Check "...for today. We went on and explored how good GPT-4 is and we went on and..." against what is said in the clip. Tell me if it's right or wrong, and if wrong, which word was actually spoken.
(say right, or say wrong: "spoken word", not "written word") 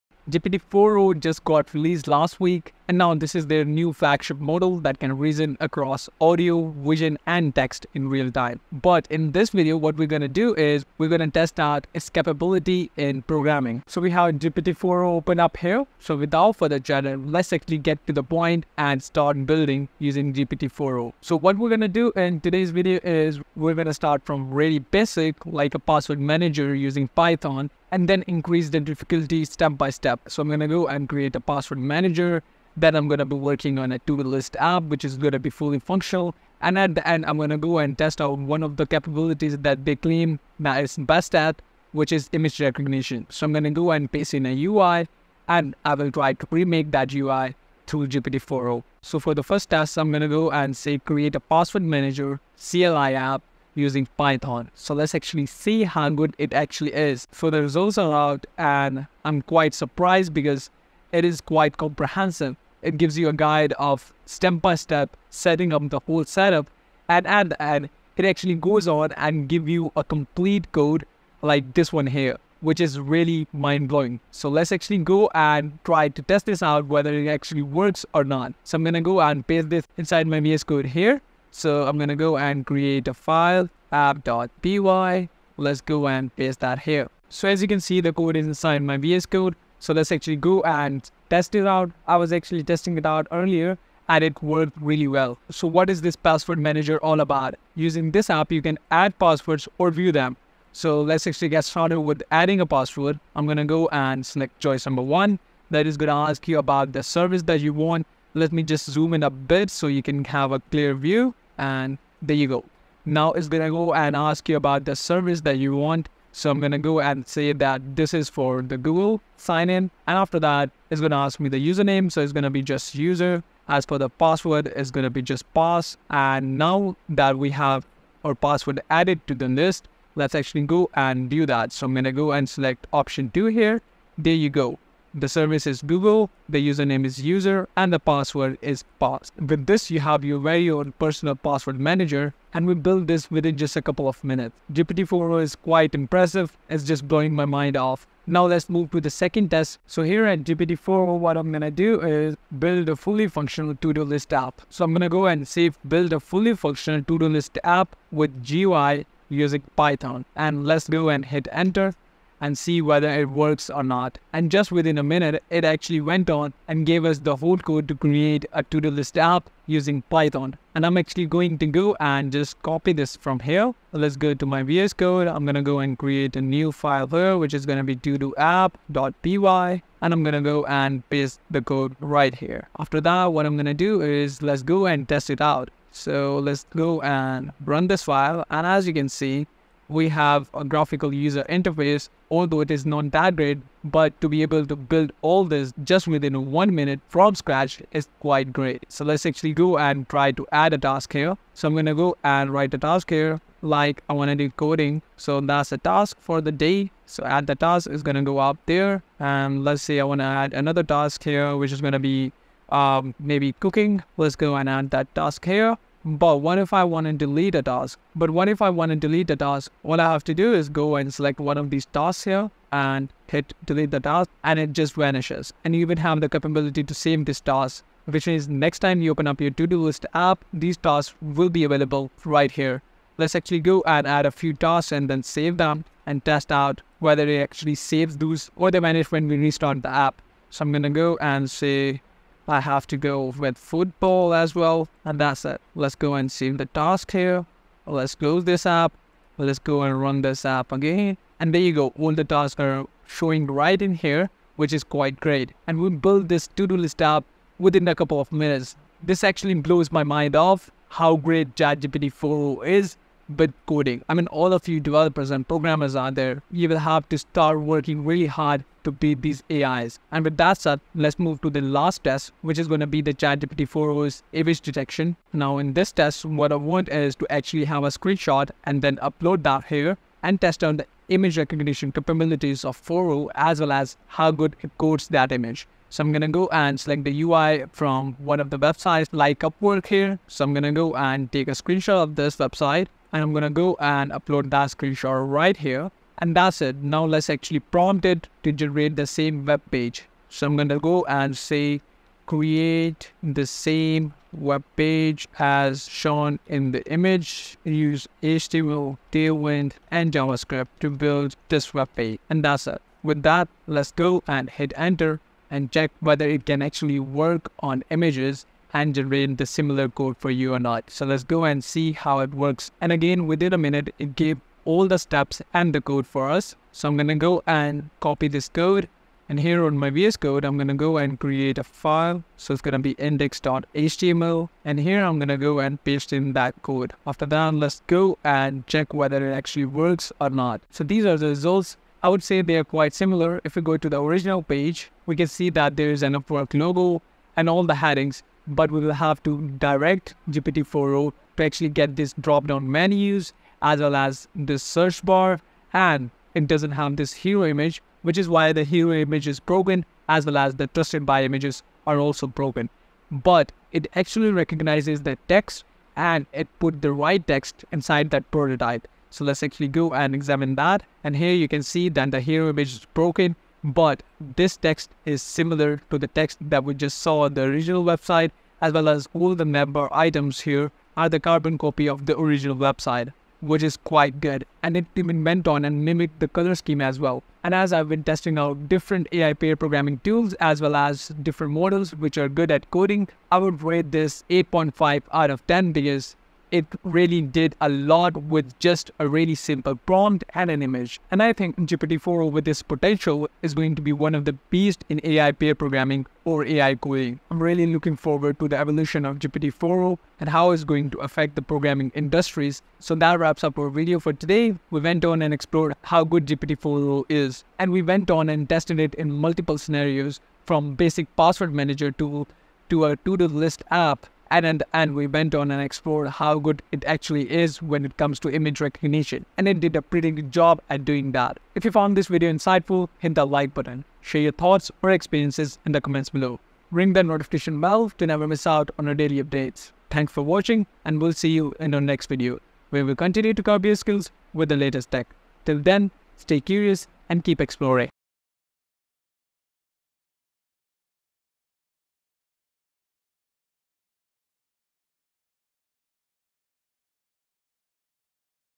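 right.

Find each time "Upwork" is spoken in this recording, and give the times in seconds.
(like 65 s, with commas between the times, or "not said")
289 s, 346 s.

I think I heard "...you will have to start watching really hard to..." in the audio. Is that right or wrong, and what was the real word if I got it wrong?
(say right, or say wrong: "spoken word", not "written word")
wrong: "working", not "watching".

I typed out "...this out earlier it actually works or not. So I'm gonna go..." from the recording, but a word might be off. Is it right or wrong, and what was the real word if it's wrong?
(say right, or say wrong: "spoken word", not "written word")
wrong: "whether", not "earlier".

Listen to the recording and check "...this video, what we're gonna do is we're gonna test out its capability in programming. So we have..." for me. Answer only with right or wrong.
right.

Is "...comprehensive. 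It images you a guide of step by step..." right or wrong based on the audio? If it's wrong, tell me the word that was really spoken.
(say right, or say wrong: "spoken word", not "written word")
wrong: "gives", not "images".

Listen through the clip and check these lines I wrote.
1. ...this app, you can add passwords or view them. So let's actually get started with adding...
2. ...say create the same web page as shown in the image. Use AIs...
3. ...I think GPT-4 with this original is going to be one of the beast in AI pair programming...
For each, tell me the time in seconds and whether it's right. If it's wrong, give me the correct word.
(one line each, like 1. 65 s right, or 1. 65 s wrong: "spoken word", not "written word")
1. 98 s right
2. 301 s wrong: "HTML", not "AIs"
3. 401 s wrong: "potential", not "original".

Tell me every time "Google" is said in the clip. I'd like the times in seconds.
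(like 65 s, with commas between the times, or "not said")
118 s, 135 s.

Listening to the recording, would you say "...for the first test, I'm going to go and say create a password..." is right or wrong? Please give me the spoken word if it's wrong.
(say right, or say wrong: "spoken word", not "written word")
right.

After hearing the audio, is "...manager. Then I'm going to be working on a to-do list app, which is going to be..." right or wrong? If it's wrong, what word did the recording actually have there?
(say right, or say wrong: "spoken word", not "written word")
right.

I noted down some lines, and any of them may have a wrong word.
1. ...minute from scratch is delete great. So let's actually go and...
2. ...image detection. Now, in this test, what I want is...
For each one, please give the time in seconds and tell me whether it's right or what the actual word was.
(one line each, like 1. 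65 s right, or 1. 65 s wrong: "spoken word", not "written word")
1. 196 s wrong: "quite", not "delete"
2. 274 s right.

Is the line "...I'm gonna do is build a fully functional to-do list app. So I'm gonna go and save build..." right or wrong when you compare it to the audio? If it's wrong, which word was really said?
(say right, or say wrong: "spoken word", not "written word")
right.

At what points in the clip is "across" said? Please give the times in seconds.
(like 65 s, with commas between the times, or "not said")
5 s.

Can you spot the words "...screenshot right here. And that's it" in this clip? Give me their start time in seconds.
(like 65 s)
294 s.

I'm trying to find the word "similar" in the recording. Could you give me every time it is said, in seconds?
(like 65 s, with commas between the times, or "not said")
319 s, 342 s, 375 s.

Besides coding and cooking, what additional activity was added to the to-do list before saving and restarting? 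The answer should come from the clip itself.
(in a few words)
football.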